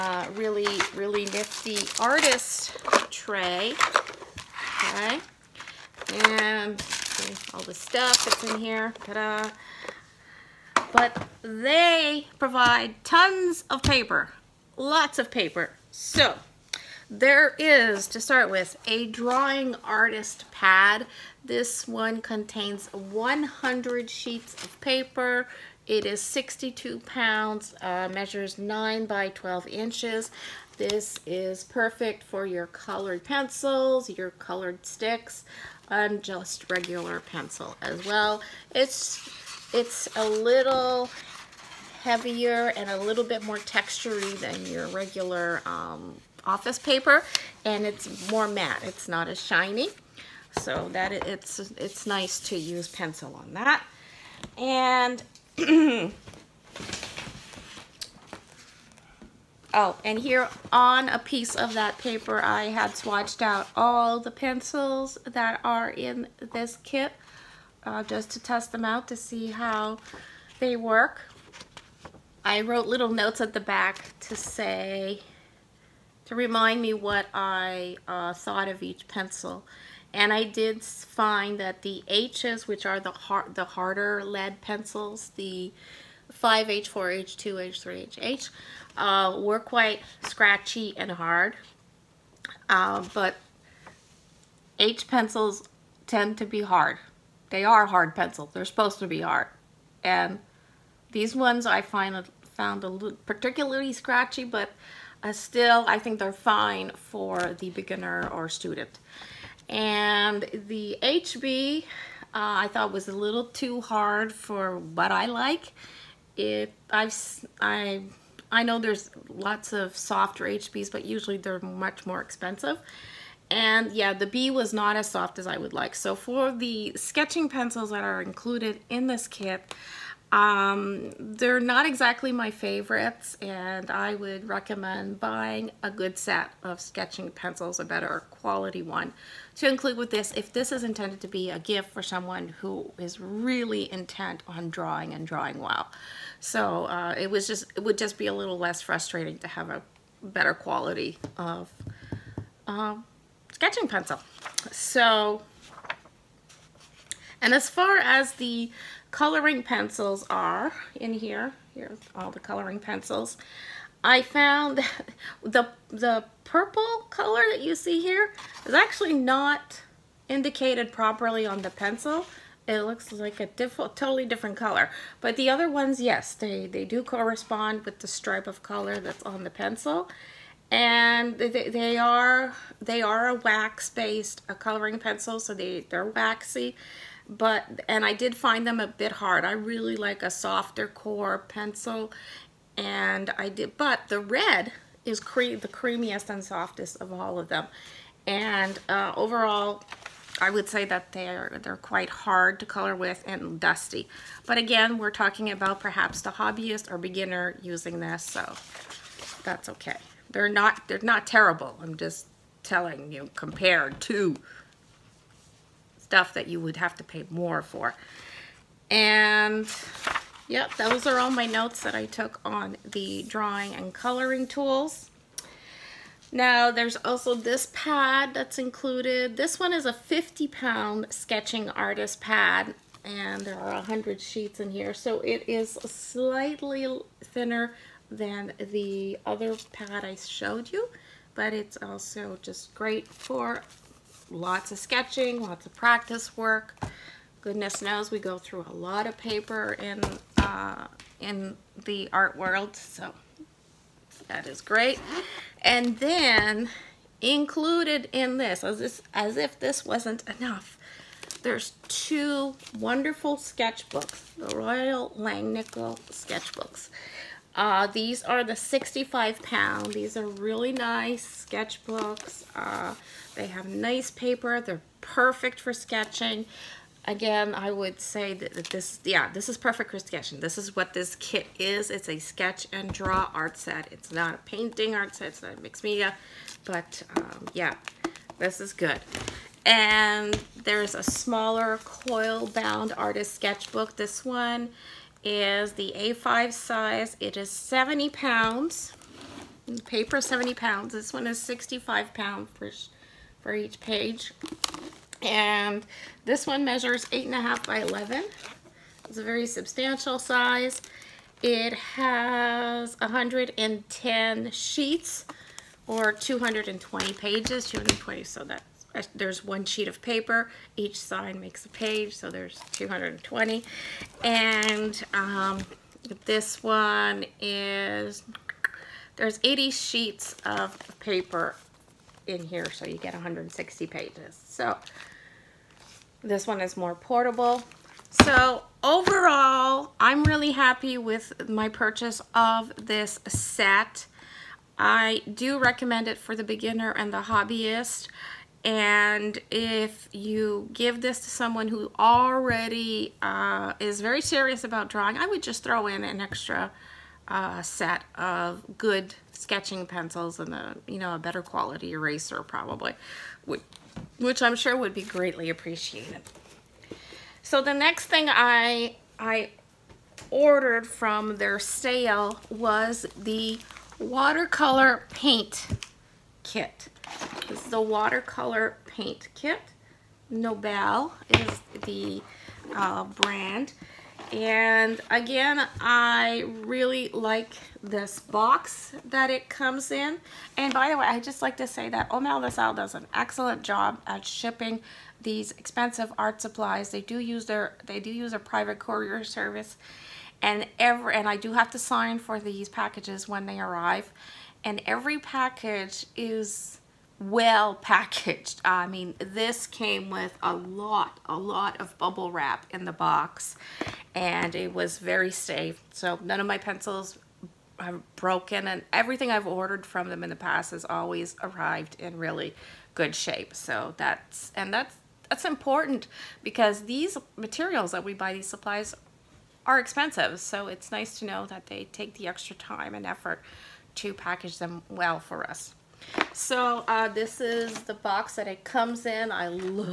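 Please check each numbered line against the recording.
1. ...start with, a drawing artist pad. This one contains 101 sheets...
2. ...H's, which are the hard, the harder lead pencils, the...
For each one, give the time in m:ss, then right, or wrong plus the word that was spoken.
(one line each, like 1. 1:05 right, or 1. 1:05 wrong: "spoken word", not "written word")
1. 0:18 wrong: "100", not "101"
2. 1:22 right.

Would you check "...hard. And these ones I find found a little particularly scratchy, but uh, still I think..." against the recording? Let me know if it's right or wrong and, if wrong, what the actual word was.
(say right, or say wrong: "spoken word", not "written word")
right.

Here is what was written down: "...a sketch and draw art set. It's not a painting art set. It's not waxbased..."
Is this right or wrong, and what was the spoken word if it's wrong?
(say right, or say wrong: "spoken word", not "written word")
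wrong: "mixed", not "waxbased".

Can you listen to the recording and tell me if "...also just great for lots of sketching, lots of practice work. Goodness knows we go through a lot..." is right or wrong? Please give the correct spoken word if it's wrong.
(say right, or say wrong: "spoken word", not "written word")
right.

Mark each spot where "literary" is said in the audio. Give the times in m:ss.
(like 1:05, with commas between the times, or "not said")
not said.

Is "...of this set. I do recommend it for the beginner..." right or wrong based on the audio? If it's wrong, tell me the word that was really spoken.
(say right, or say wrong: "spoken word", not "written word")
right.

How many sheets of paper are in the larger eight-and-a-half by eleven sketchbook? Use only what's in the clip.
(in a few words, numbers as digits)
110.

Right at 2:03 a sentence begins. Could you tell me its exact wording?
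And yeah, the B was not as soft as I would like.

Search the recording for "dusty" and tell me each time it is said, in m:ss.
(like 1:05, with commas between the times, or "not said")
3:23.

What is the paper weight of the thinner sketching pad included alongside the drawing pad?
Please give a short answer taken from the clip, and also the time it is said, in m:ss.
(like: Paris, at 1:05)
50 pound, at 3:49.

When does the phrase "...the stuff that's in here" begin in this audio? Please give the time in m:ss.
0:07.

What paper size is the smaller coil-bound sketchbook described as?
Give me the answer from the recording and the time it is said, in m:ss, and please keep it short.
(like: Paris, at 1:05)
A5, at 4:55.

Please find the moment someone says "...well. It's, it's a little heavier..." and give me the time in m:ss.
0:38.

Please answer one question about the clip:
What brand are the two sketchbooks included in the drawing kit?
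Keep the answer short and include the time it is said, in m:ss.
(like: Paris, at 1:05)
Royal Langnickel, at 4:24.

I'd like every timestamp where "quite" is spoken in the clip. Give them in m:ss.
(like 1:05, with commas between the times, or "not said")
1:29, 3:21.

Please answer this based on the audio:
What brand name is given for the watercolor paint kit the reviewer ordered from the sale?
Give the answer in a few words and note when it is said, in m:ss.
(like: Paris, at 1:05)
Nobel, at 6:20.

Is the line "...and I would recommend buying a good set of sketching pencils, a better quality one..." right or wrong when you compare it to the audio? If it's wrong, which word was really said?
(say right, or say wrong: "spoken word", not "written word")
right.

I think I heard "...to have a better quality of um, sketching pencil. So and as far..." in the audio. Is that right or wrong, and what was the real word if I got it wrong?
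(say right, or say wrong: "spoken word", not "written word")
right.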